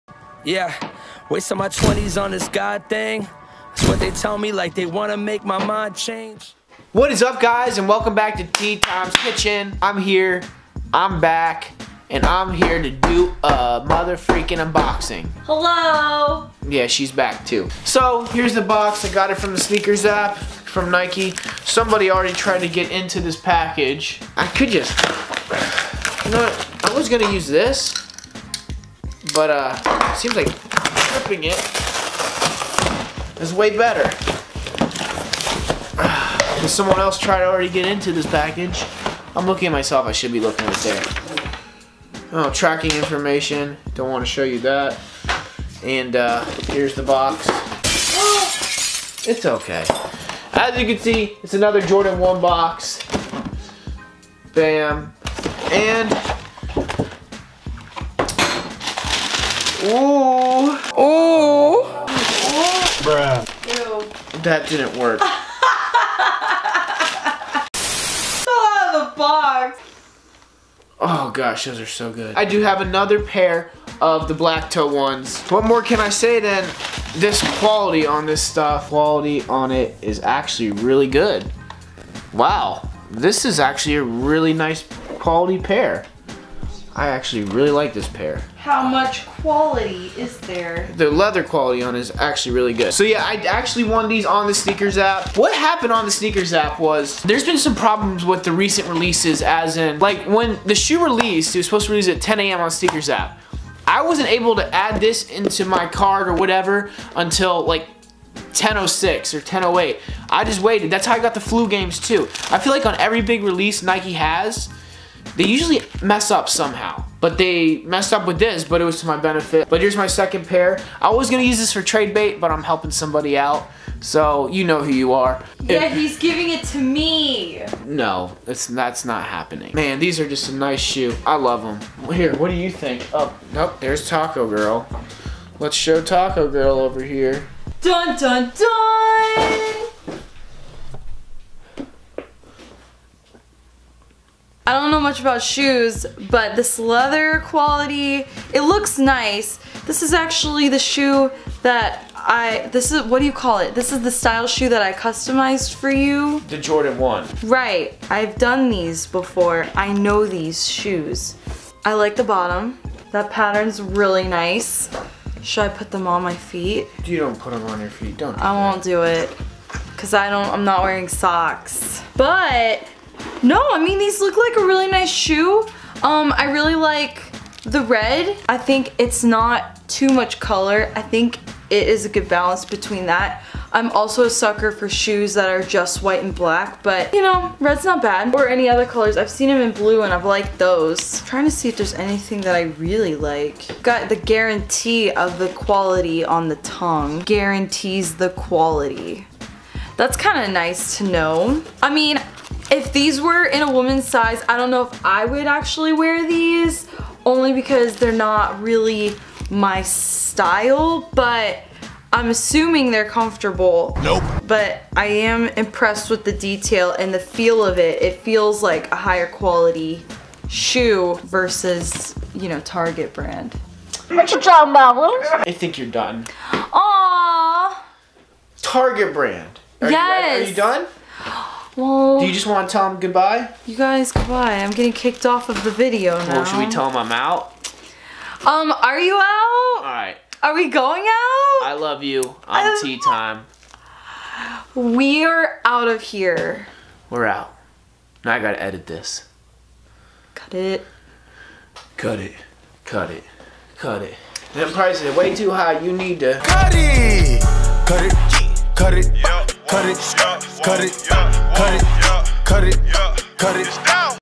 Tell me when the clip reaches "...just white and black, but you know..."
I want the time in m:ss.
3:05.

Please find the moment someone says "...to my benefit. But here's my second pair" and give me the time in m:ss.
1:59.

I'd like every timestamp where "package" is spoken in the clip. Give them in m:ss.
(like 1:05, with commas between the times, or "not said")
0:23, 0:38.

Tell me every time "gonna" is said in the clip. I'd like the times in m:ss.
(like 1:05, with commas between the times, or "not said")
0:27, 2:01.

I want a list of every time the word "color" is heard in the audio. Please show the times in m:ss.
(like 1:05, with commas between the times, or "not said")
3:00, 3:08.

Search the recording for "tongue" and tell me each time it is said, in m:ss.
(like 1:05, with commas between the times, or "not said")
3:16.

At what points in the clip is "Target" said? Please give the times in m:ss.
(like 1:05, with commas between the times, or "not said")
3:42, 3:48.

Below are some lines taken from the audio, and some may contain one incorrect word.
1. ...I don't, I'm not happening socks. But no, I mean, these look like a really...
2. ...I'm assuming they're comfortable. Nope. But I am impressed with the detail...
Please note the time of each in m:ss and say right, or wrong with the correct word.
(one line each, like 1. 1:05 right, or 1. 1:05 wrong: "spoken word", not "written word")
1. 2:50 wrong: "wearing", not "happening"
2. 3:32 right.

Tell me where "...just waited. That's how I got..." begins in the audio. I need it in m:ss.
1:50.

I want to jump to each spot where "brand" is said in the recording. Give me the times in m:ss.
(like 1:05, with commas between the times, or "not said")
3:43, 3:49.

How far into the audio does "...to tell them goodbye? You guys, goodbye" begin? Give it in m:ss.
3:52.